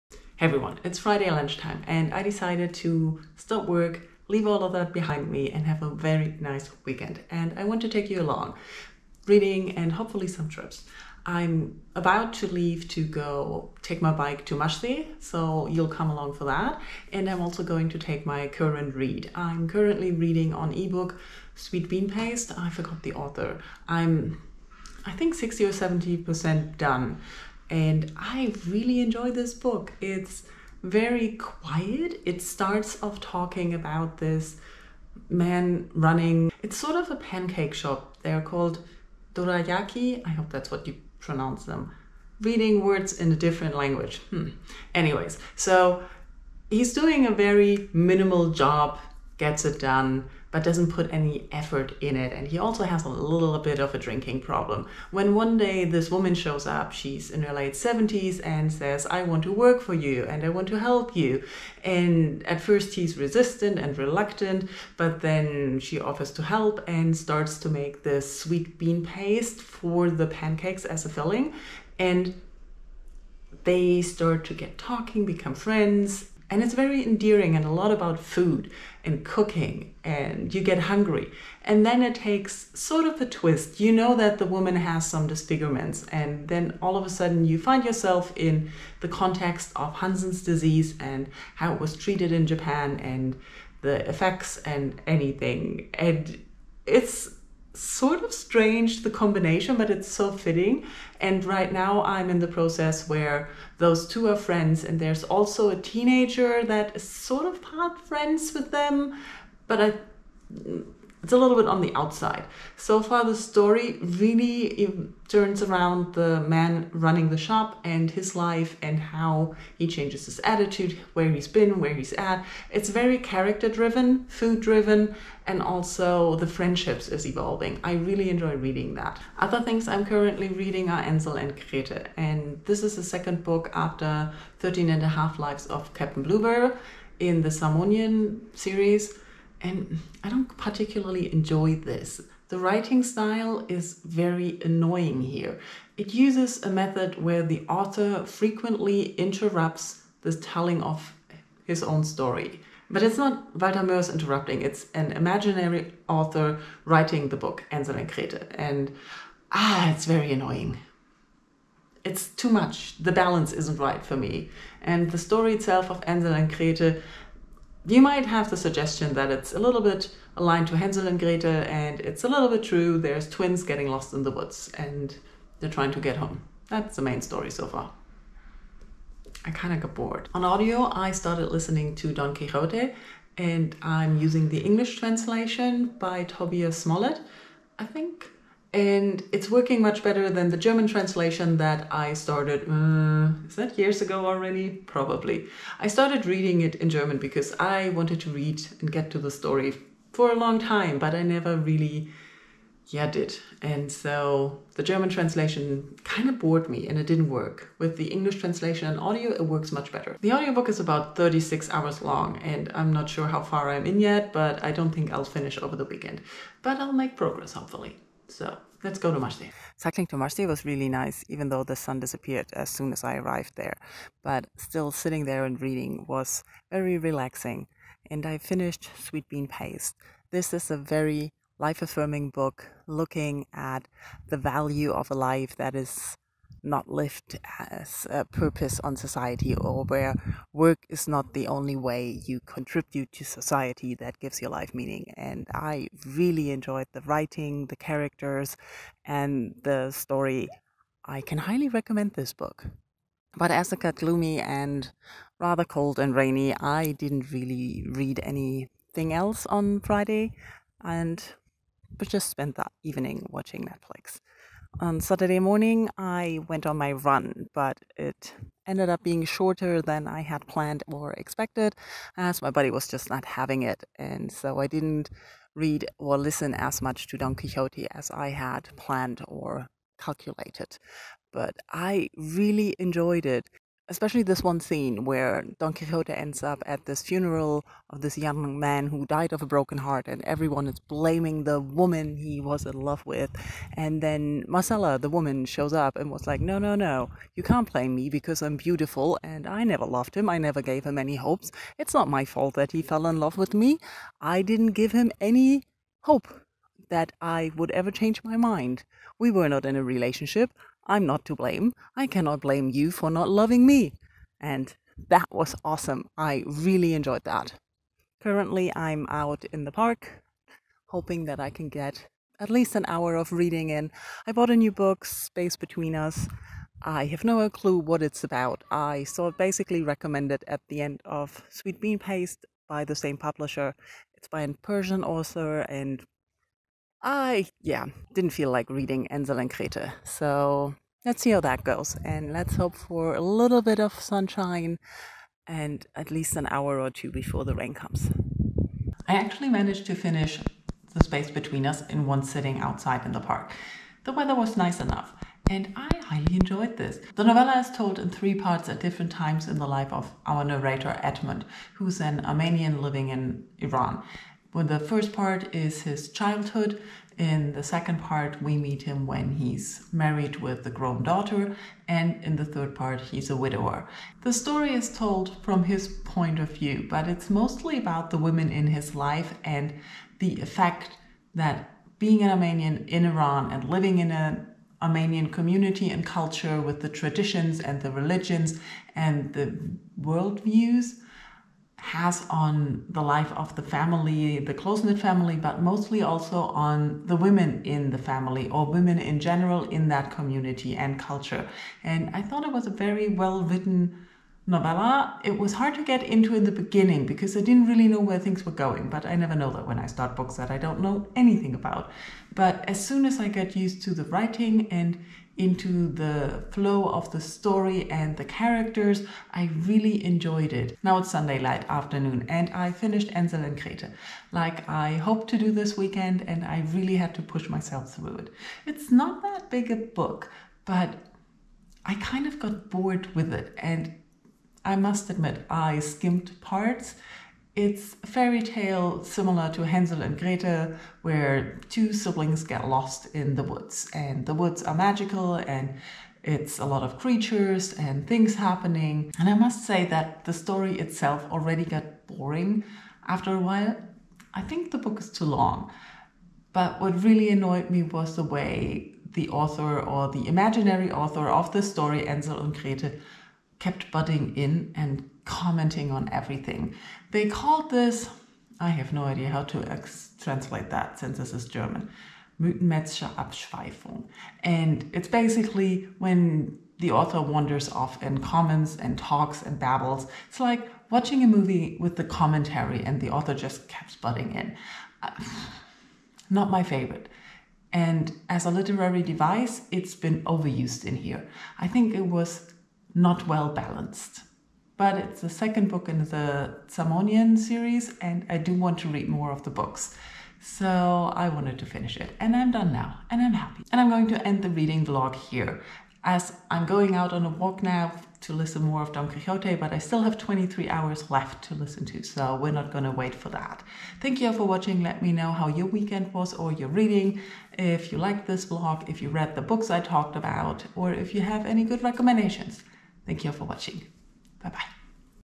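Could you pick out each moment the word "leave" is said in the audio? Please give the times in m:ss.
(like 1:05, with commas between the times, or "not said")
0:04, 0:12.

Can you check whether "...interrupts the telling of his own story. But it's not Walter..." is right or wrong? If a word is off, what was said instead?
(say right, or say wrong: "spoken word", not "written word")
right.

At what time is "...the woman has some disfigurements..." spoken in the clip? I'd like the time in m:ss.
1:24.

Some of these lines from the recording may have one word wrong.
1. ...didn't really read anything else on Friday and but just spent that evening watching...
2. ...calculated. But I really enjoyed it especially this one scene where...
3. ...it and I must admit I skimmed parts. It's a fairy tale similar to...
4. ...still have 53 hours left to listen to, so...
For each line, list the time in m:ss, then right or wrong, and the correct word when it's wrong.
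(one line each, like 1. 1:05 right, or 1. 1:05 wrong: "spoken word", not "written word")
1. 4:16 right
2. 4:39 right
3. 7:13 right
4. 8:29 wrong: "23", not "53".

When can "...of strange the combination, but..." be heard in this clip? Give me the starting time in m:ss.
1:38.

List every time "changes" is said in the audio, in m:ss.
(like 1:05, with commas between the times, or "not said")
1:59, 5:07.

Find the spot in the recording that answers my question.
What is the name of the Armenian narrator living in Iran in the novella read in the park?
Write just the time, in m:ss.
6:01.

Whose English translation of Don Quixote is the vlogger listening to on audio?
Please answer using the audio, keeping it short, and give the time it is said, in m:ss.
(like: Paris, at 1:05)
Tobias Smollett, at 3:06.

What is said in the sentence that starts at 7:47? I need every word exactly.
They called this, I have no idea how to ex- translate that since this is German, Mythenmetzsche Abschweifung.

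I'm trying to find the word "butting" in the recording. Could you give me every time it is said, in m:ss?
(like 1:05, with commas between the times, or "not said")
7:43, 8:03.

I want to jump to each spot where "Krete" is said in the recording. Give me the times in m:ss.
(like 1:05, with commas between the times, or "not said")
2:11, 2:38, 2:46, 5:39, 7:03, 7:42.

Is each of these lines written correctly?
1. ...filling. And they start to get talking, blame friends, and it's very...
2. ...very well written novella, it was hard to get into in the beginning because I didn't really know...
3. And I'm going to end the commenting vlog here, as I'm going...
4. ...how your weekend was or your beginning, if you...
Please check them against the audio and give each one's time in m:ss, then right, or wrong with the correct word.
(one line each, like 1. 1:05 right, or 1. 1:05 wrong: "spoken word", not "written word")
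1. 1:11 wrong: "become", not "blame"
2. 6:42 right
3. 8:23 wrong: "reading", not "commenting"
4. 8:35 wrong: "reading", not "beginning".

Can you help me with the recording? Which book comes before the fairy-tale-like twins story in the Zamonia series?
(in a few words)
13 and a half lives of Captain Bluebear.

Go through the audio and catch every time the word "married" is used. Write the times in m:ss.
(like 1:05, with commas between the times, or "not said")
6:09.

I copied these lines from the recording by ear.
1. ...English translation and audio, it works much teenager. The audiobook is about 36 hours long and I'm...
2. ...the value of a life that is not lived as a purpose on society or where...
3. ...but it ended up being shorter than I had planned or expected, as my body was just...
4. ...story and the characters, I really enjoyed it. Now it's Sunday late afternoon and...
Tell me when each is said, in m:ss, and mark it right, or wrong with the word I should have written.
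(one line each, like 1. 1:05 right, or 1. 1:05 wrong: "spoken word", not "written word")
1. 3:28 wrong: "better", not "teenager"
2. 3:54 right
3. 4:27 right
4. 6:57 right.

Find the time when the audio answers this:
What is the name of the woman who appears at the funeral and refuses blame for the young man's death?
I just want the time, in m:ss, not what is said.
4:54.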